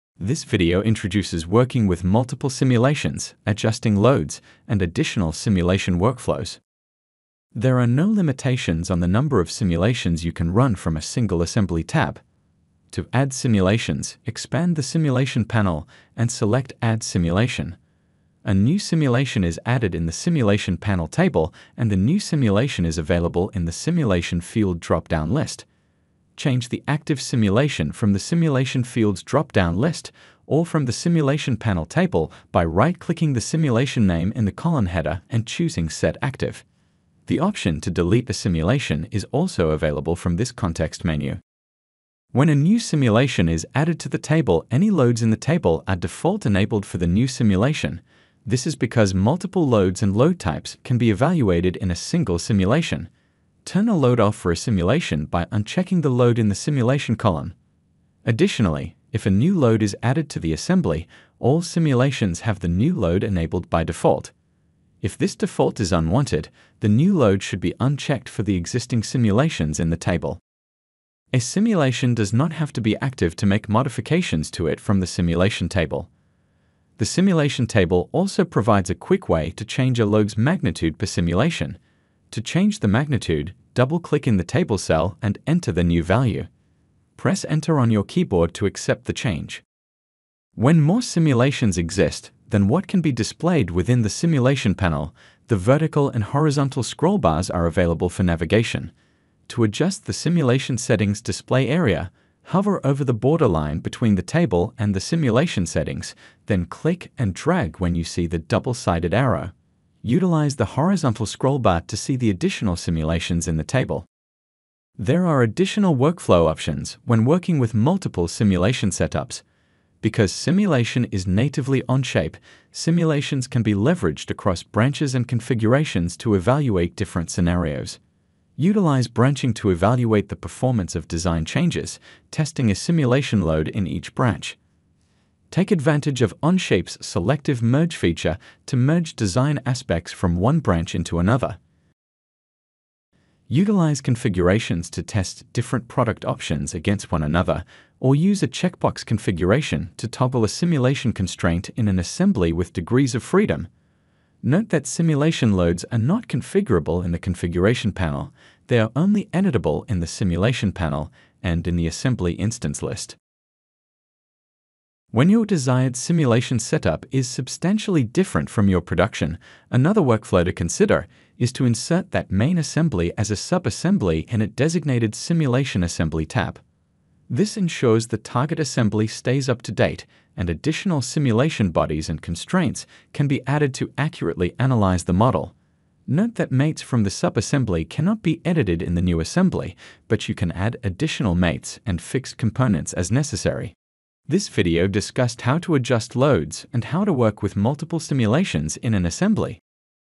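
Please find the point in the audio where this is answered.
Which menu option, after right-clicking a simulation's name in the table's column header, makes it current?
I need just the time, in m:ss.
0:35.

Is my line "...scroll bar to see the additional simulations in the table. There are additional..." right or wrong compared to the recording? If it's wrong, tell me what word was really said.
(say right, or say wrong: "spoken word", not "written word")
right.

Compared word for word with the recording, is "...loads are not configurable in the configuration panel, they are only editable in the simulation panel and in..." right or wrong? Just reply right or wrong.
right.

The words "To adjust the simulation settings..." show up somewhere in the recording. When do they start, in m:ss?
1:39.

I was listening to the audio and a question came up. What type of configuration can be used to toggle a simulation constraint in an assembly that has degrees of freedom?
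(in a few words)
checkbox configuration.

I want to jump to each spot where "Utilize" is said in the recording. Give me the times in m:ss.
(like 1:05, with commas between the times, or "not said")
1:50, 2:08, 2:23.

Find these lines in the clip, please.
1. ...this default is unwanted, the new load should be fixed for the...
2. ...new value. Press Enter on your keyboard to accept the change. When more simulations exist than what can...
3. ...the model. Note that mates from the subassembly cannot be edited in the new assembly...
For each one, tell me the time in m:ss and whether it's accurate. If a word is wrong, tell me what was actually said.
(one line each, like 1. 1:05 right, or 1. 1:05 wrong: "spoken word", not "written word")
1. 1:05 wrong: "unchecked", not "fixed"
2. 1:25 right
3. 3:05 right.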